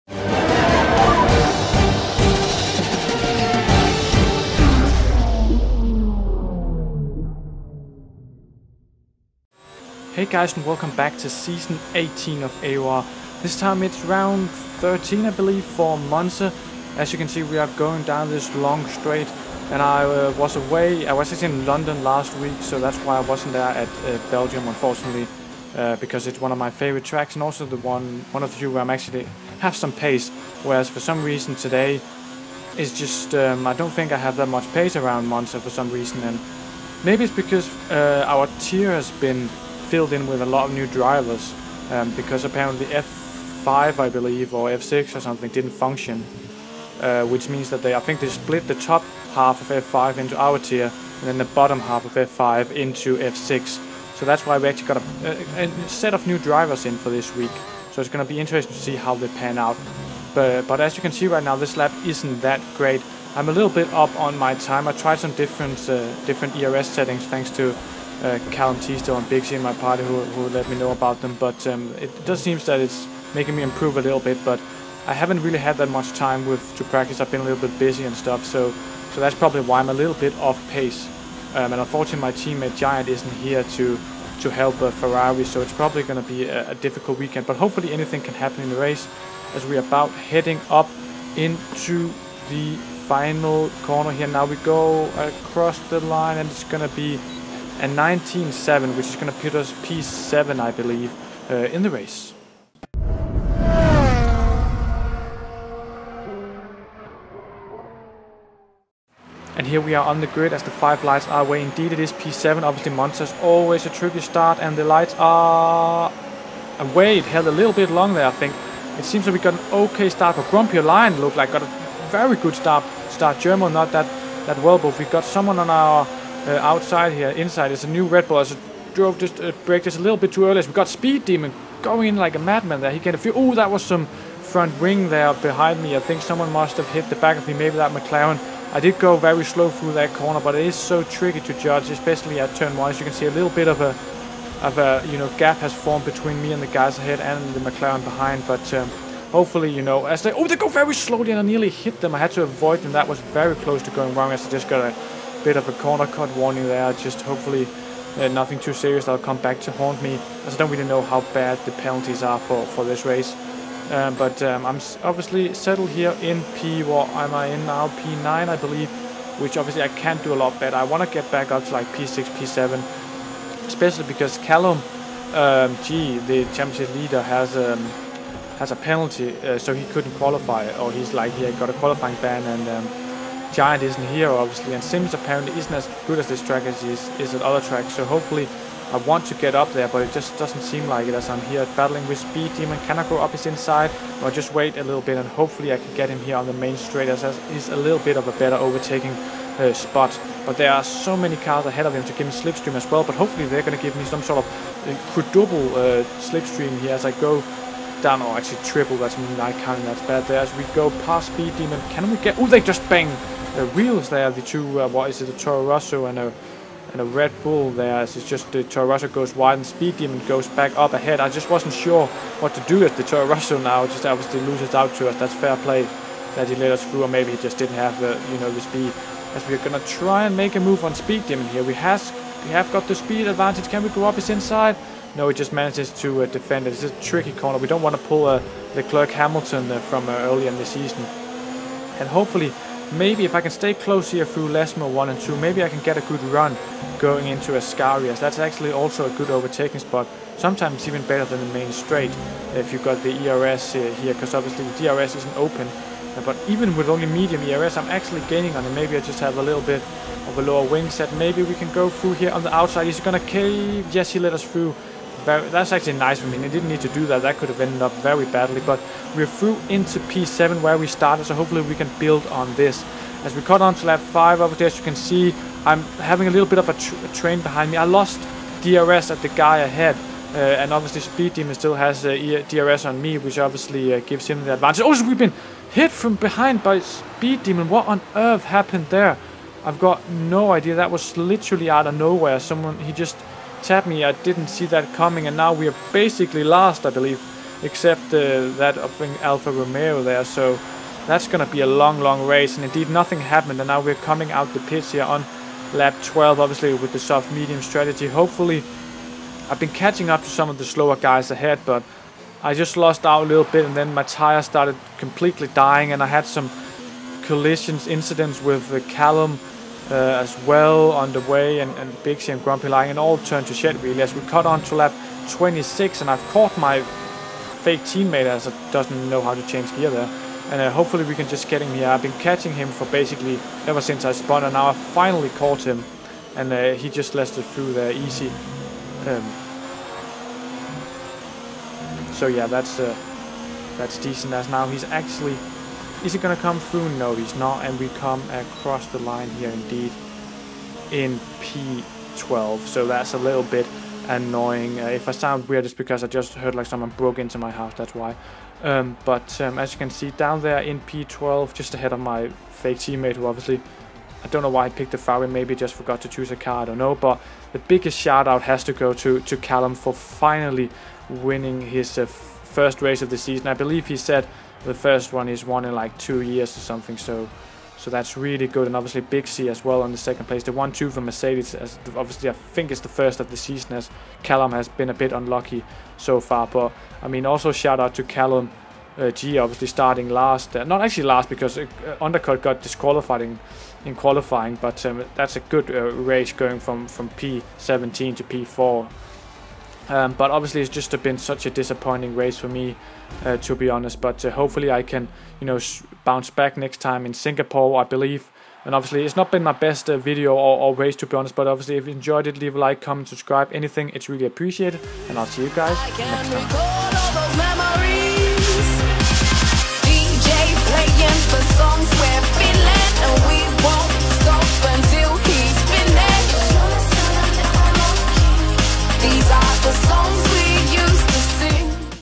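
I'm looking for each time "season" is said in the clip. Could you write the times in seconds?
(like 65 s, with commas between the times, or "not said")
11 s, 240 s, 373 s, 383 s.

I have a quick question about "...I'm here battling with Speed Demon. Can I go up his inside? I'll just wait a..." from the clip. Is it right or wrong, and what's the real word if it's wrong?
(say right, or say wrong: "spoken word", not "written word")
right.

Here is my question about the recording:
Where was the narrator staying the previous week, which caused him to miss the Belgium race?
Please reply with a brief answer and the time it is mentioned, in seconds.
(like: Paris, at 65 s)
London, at 21 s.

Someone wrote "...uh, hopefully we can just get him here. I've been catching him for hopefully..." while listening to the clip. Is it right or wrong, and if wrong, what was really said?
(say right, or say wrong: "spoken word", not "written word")
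wrong: "basically", not "hopefully".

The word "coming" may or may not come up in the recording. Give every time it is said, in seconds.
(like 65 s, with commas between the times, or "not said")
294 s, 304 s.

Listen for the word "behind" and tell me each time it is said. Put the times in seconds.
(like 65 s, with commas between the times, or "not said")
135 s, 148 s, 277 s, 286 s.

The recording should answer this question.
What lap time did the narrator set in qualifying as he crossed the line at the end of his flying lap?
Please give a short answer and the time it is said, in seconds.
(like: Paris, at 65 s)
1:19.7, at 97 s.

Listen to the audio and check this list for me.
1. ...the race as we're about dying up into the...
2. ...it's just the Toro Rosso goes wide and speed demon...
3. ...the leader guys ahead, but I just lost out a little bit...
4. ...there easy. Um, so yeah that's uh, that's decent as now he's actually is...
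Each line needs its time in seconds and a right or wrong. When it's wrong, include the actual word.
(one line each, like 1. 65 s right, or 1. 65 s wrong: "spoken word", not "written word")
1. 88 s wrong: "heading", not "dying"
2. 218 s right
3. 310 s wrong: "slower", not "leader"
4. 337 s right.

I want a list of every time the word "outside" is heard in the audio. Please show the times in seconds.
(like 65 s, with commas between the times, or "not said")
126 s, 262 s.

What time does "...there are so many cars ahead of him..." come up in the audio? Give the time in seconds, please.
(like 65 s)
200 s.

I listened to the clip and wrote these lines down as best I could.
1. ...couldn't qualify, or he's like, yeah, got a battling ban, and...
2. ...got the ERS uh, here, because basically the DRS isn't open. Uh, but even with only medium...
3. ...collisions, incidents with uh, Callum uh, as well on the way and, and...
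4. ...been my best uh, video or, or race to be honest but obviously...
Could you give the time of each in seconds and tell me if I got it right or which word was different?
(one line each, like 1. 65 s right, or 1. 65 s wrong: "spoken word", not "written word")
1. 179 s wrong: "qualifying", not "battling"
2. 252 s wrong: "obviously", not "basically"
3. 317 s right
4. 409 s right.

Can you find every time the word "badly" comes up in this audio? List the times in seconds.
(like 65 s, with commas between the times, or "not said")
268 s.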